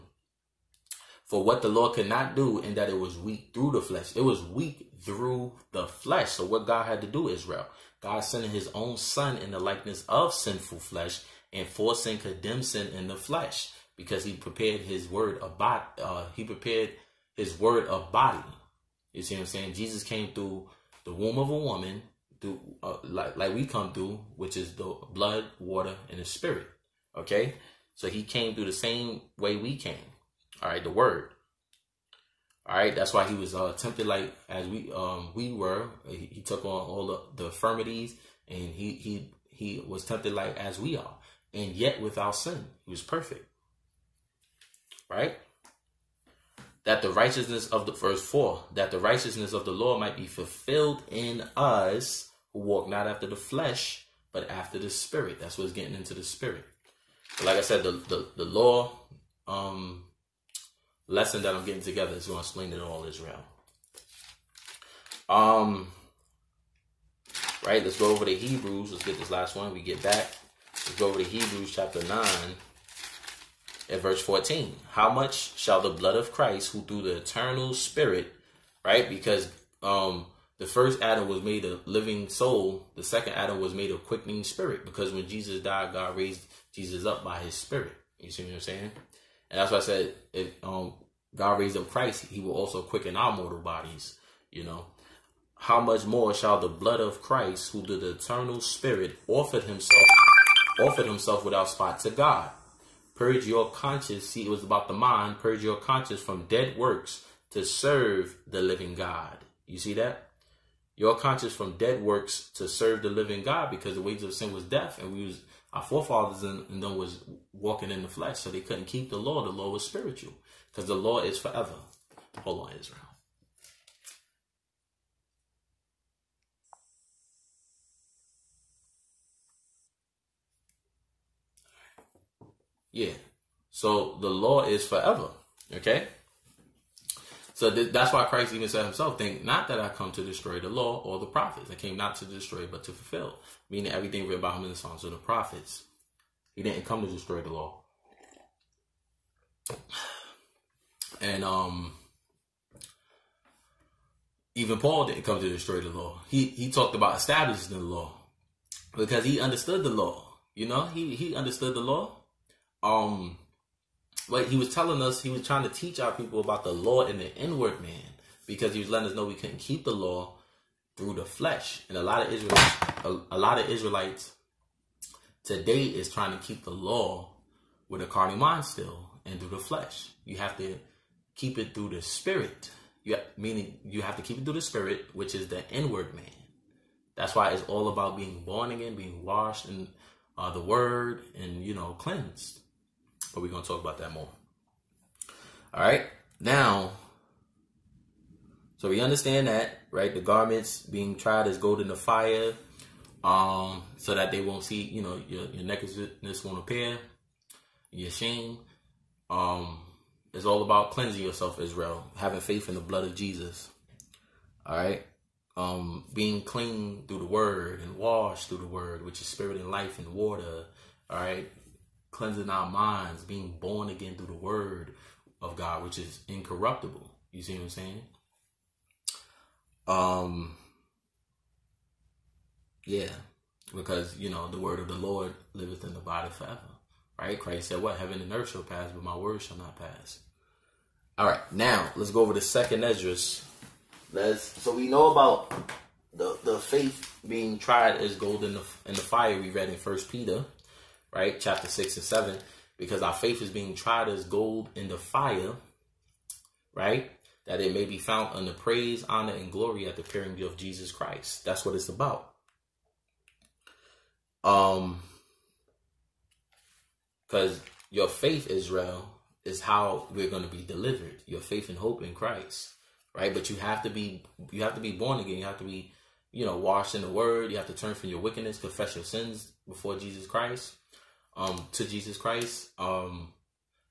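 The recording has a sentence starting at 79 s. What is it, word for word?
Because um, the first Adam was made a living soul.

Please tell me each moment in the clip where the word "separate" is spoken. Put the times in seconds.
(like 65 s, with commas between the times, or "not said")
not said.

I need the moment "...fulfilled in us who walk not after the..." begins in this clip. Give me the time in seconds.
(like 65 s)
50 s.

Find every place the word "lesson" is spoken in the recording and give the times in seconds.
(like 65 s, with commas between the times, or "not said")
61 s.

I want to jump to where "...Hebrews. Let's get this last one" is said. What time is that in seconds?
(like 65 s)
68 s.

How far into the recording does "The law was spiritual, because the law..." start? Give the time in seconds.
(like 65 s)
119 s.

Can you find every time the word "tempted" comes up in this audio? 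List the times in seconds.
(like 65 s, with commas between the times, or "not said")
33 s, 40 s.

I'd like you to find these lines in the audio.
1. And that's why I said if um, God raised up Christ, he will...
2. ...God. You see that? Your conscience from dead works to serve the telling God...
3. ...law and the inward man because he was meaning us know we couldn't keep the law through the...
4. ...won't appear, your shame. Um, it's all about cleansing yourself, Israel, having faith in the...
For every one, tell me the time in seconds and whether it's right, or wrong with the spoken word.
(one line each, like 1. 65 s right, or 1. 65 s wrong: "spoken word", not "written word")
1. 89 s right
2. 108 s wrong: "living", not "telling"
3. 166 s wrong: "letting", not "meaning"
4. 206 s right.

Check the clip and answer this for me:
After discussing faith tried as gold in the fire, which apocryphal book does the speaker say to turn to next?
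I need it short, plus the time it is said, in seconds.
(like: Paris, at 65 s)
Second Esdras, at 242 s.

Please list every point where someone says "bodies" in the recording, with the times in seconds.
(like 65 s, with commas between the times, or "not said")
93 s.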